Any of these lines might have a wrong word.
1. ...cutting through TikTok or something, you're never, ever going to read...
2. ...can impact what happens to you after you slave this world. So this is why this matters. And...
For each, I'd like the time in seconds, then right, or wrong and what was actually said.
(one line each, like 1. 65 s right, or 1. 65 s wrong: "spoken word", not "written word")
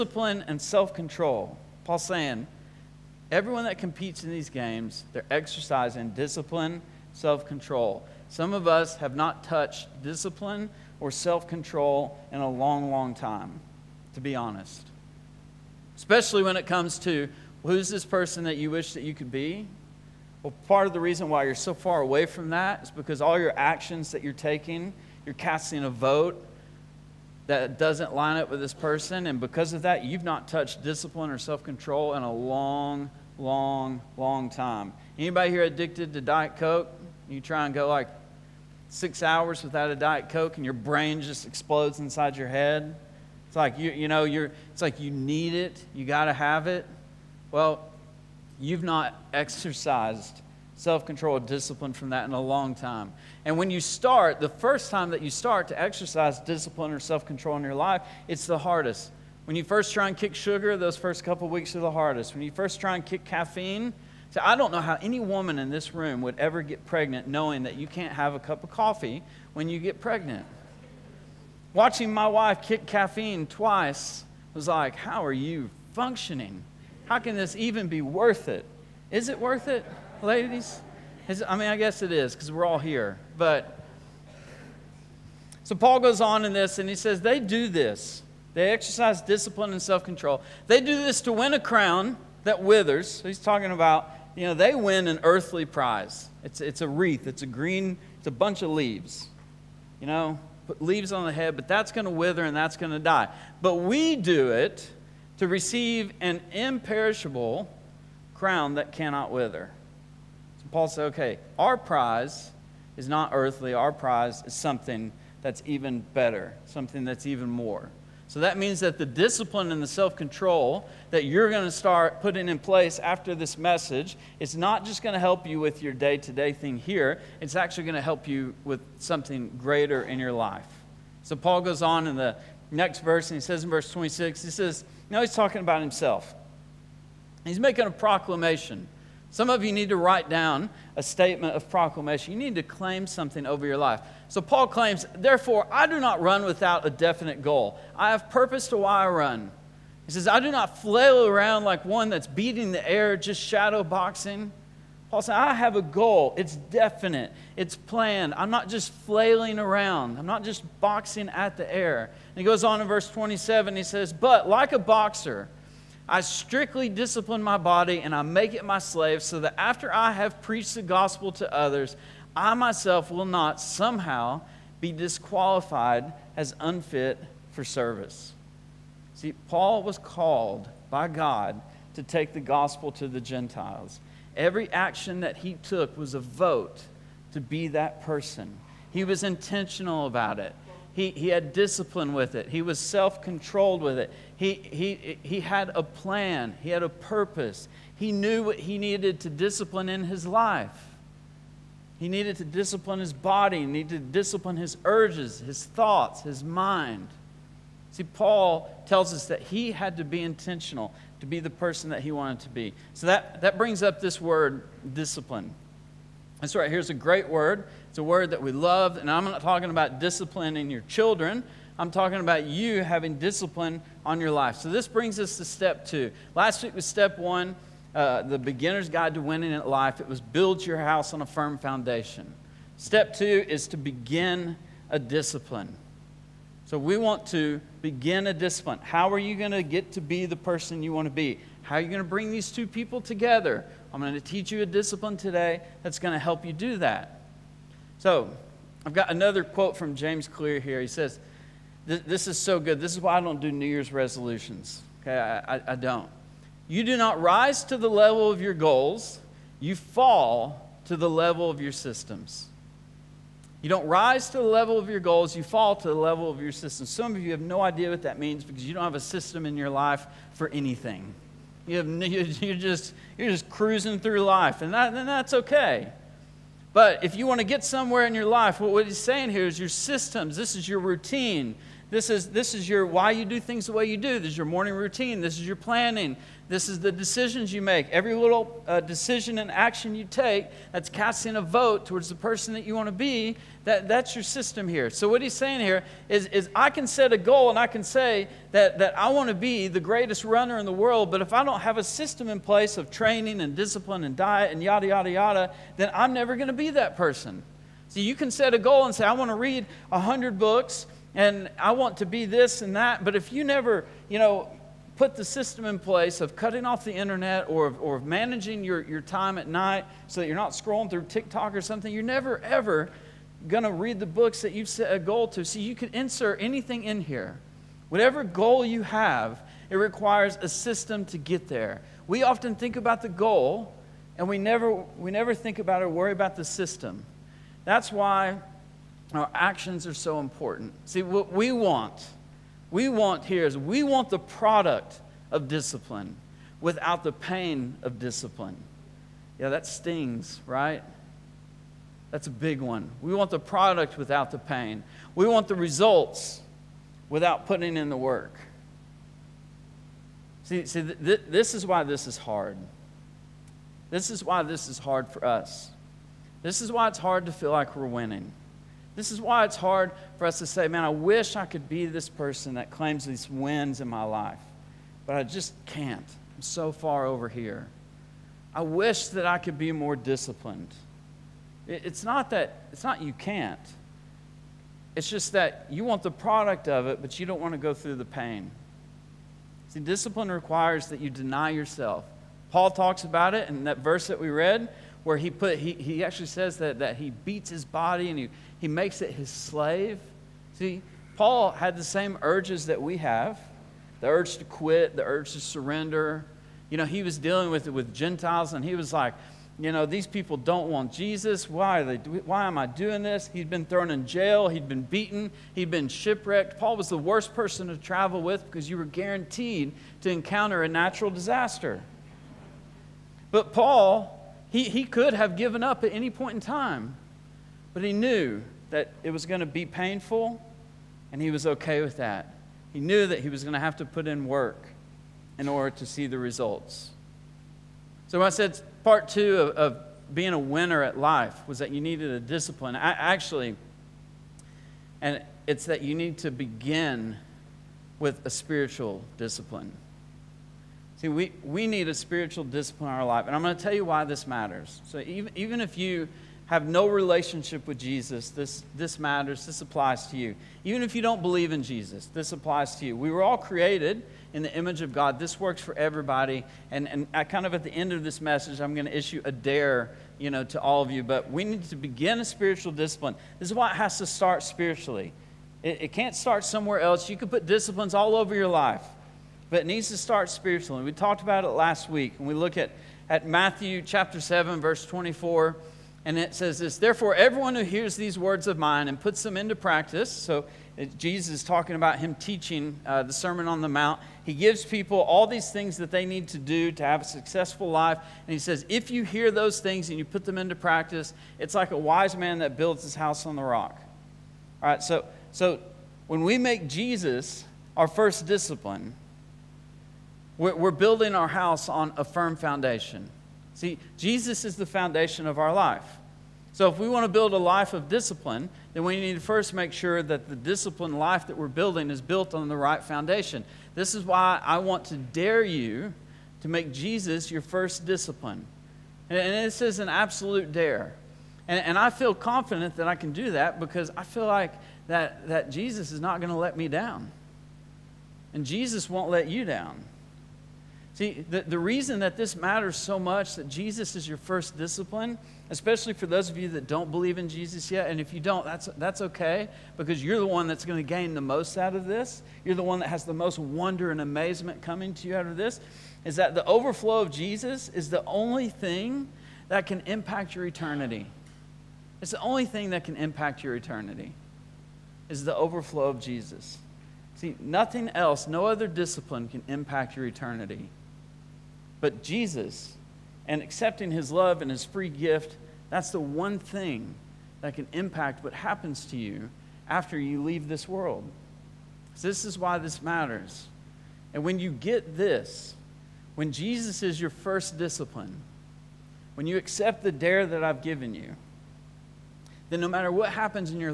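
1. 320 s wrong: "scrolling", not "cutting"
2. 577 s wrong: "leave", not "slave".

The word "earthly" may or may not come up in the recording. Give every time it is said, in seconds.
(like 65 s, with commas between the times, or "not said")
95 s, 113 s.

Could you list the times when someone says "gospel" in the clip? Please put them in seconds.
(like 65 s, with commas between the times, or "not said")
170 s, 182 s.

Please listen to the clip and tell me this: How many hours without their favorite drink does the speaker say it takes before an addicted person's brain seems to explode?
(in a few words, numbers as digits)
6.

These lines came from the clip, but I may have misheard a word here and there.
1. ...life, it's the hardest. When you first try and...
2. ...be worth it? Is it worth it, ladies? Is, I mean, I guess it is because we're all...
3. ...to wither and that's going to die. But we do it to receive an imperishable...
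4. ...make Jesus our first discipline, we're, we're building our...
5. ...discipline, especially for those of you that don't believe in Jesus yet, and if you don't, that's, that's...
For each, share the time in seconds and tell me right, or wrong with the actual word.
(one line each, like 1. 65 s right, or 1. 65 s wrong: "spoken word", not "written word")
1. 57 s right
2. 77 s right
3. 102 s right
4. 506 s right
5. 544 s right.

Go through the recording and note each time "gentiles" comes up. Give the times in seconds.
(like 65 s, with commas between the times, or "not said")
183 s, 407 s.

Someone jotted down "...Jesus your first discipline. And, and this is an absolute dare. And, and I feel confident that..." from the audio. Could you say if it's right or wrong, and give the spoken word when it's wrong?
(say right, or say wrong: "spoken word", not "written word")
right.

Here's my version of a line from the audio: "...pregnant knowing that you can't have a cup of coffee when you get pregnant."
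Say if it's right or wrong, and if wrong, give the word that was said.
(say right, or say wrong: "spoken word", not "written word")
right.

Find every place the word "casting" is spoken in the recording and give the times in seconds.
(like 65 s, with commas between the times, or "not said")
25 s, 290 s.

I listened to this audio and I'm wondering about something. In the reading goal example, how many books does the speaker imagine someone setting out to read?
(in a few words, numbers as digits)
100.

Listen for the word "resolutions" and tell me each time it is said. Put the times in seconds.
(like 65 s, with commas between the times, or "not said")
253 s.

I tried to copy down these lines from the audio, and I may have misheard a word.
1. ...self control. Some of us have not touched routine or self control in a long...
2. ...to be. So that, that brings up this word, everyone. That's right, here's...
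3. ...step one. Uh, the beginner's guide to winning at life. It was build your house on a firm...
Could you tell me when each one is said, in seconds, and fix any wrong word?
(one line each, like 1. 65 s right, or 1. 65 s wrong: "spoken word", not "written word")
1. 7 s wrong: "discipline", not "routine"
2. 212 s wrong: "discipline", not "everyone"
3. 226 s right.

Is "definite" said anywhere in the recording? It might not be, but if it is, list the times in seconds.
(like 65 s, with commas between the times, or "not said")
146 s, 156 s.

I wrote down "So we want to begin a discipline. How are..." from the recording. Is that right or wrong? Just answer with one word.
right.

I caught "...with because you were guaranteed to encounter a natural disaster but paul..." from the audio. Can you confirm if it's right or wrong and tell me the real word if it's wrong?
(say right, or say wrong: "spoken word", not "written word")
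right.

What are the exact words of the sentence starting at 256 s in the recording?
You do not rise to the level of your goals, you fall to the level of your systems.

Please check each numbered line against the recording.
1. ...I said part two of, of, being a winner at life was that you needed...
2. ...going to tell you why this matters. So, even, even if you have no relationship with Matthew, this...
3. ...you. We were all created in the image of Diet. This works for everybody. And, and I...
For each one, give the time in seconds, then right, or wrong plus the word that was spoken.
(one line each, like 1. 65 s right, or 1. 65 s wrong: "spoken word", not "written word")
1. 438 s right
2. 453 s wrong: "Jesus", not "Matthew"
3. 462 s wrong: "God", not "Diet".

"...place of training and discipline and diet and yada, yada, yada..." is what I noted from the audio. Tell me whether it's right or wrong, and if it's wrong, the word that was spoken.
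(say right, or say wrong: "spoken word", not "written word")
right.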